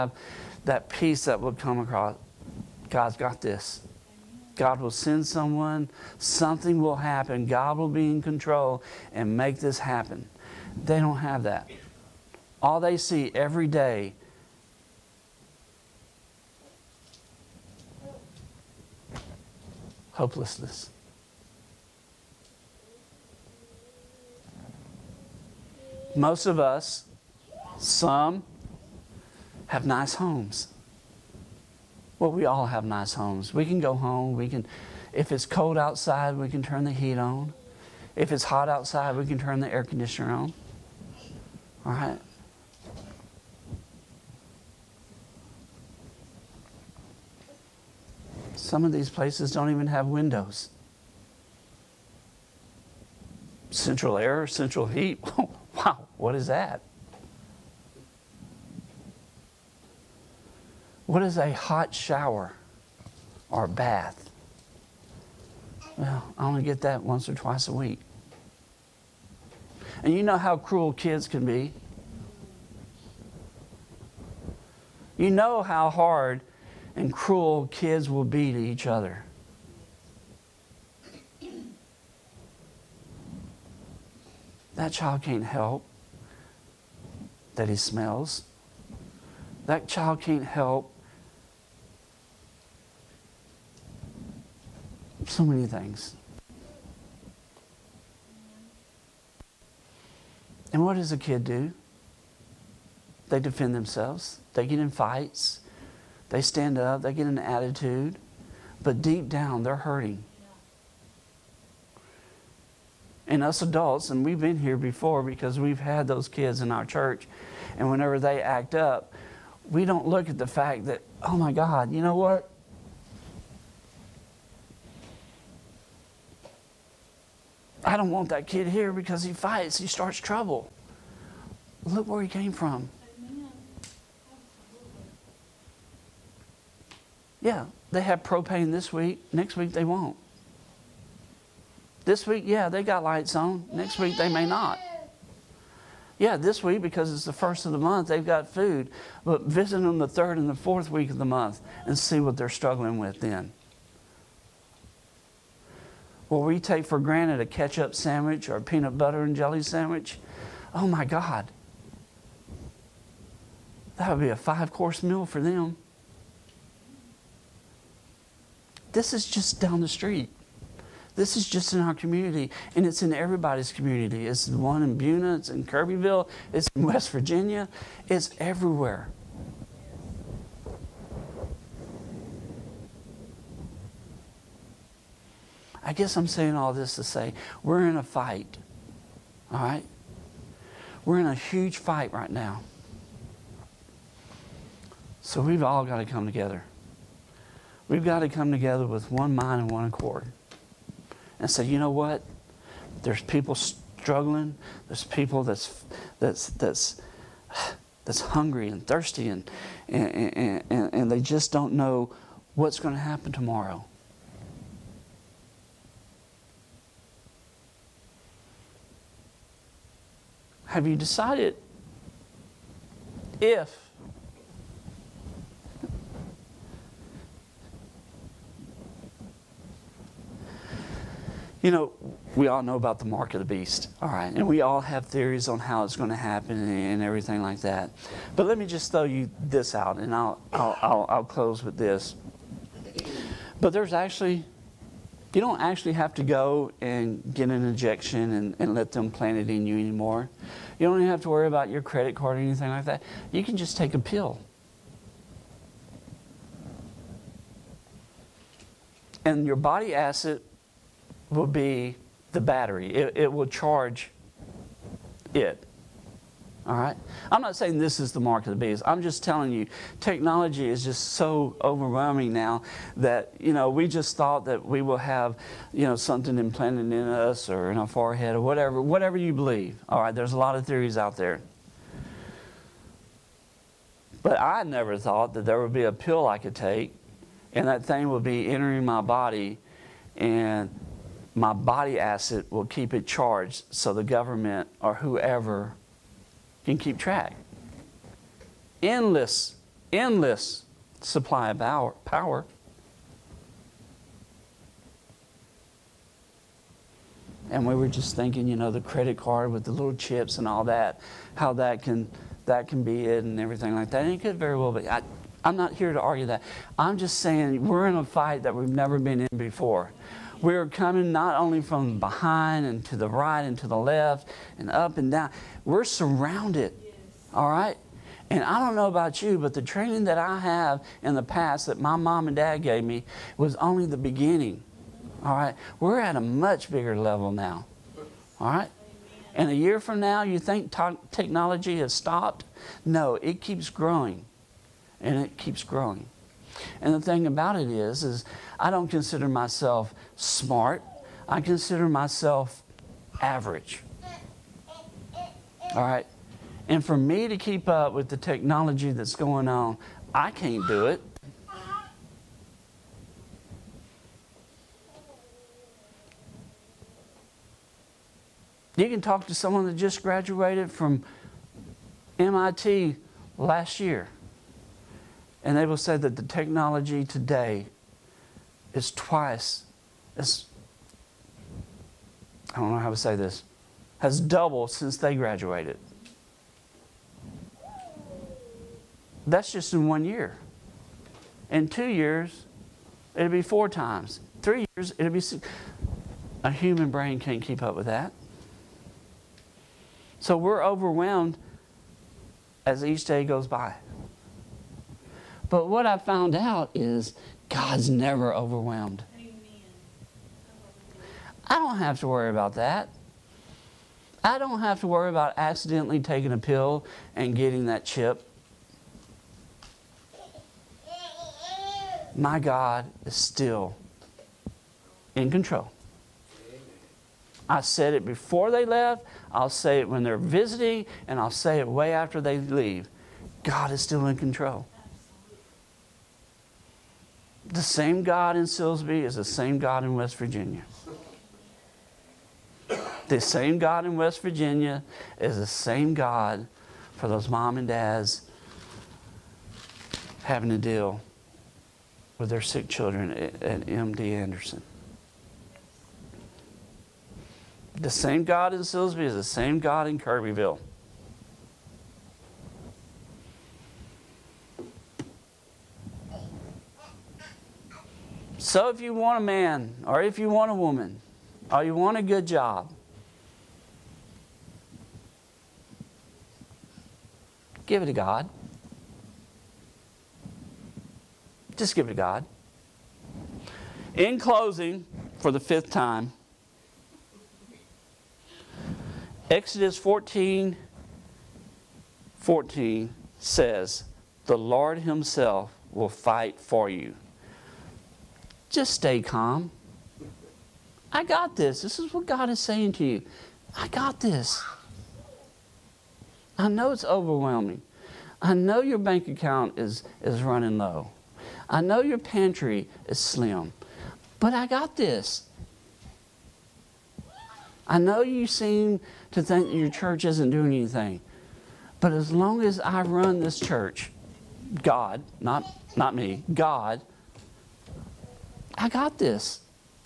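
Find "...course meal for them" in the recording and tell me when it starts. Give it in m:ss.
2:44.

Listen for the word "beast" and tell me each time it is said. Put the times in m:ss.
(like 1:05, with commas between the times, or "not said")
3:53, 4:28.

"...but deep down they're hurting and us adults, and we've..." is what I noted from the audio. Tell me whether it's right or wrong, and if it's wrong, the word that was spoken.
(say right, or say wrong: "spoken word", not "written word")
right.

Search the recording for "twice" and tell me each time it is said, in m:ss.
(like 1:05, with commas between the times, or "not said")
1:07, 6:18.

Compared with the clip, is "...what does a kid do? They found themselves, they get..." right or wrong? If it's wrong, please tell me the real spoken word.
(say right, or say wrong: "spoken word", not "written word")
wrong: "defend", not "found".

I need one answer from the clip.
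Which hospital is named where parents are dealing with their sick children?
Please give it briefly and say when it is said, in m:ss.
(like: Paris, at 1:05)
MD Anderson, at 7:33.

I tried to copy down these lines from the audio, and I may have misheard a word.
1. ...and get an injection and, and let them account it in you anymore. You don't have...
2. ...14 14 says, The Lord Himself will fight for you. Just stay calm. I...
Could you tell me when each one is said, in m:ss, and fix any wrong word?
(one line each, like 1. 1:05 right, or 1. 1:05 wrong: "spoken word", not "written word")
1. 4:06 wrong: "plant", not "account"
2. 8:09 right.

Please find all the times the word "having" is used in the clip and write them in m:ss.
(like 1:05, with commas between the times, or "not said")
7:30.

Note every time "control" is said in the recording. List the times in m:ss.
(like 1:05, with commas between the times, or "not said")
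0:08, 7:05, 7:14.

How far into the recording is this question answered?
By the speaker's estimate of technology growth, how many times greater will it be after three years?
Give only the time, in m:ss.
6:35.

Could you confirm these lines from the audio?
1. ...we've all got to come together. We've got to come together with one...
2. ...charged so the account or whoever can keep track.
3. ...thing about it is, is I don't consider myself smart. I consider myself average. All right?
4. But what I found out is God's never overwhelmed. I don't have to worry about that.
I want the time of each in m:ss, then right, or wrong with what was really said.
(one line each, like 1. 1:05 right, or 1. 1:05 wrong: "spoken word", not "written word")
1. 3:15 right
2. 4:53 wrong: "government", not "account"
3. 5:46 right
4. 6:45 right.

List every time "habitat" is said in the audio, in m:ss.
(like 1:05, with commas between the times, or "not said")
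not said.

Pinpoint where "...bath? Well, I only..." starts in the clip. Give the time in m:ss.
1:03.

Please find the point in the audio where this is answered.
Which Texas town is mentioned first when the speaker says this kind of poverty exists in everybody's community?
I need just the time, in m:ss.
2:54.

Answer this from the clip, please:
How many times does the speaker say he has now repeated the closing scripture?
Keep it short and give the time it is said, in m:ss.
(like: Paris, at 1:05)
5, at 8:05.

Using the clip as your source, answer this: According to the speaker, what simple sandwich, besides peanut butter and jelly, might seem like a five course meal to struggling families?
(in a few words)
Ketchup sandwich.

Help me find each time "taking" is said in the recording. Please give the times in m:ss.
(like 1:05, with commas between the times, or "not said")
6:55.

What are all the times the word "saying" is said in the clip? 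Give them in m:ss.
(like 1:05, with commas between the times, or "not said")
3:06, 4:27, 5:17, 8:22.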